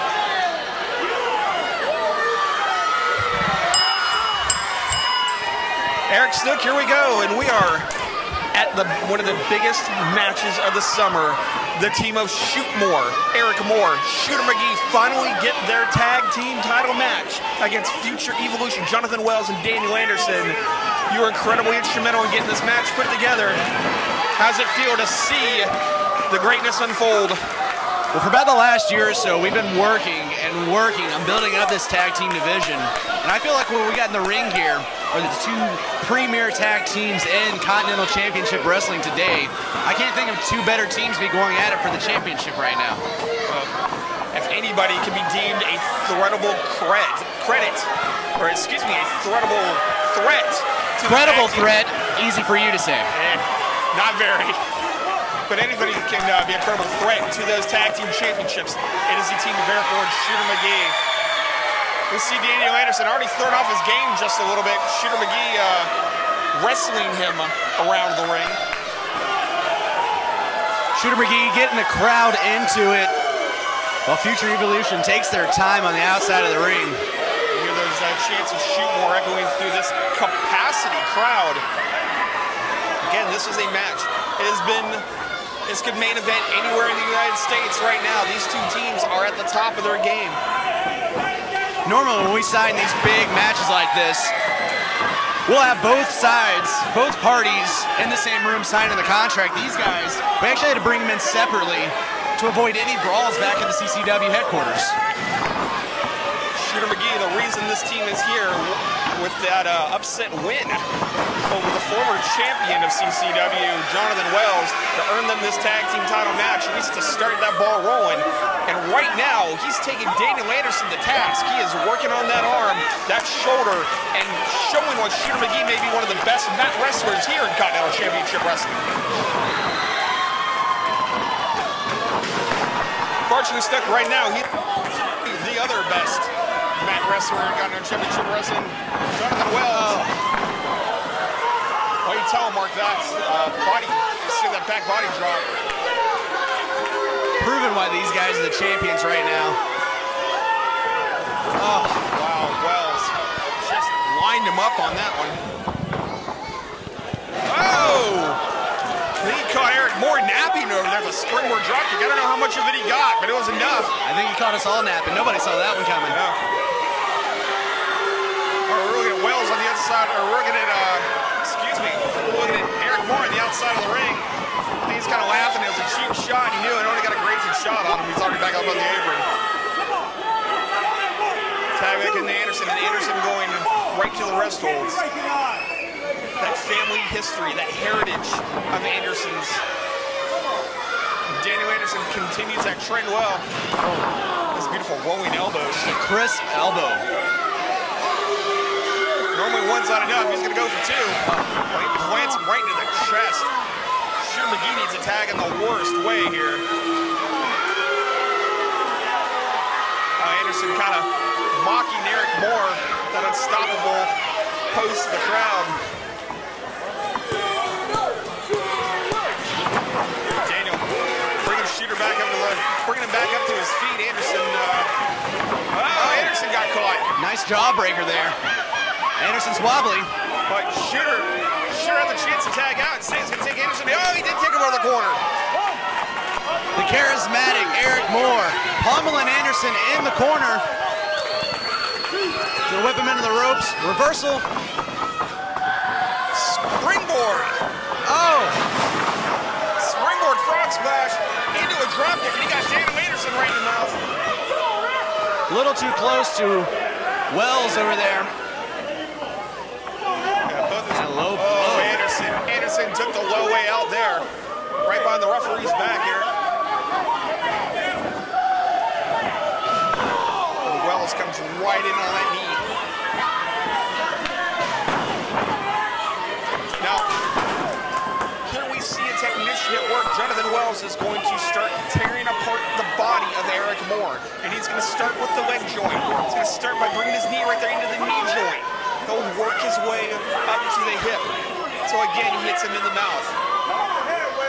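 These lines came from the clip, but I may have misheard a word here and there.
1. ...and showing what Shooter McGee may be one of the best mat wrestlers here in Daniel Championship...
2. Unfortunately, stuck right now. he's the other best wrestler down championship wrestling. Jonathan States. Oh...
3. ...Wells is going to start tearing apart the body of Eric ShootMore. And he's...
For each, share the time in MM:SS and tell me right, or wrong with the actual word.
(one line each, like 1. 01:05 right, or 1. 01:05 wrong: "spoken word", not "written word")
1. 02:04 wrong: "Continental", not "Daniel"
2. 02:13 wrong: "Wells", not "States"
3. 04:40 wrong: "Moore", not "ShootMore".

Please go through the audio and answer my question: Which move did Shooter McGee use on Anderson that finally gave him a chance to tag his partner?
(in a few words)
Jawbreaker.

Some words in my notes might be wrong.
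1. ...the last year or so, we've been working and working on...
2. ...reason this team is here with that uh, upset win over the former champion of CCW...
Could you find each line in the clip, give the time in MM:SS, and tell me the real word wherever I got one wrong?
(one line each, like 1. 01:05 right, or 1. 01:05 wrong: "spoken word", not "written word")
1. 00:28 right
2. 01:47 right.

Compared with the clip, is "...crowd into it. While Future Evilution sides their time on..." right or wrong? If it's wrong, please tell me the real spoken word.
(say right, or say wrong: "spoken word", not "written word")
wrong: "takes", not "sides".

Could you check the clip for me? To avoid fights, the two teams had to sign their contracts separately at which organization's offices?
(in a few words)
CCW headquarters.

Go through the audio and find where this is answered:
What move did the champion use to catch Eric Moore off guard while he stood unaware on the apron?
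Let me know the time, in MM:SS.
02:41.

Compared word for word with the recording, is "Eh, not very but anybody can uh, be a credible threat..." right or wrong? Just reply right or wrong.
right.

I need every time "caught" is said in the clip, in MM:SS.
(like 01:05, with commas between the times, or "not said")
02:39, 02:44, 03:46.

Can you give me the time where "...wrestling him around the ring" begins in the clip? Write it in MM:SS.
01:06.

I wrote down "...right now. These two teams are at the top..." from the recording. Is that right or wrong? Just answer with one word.
right.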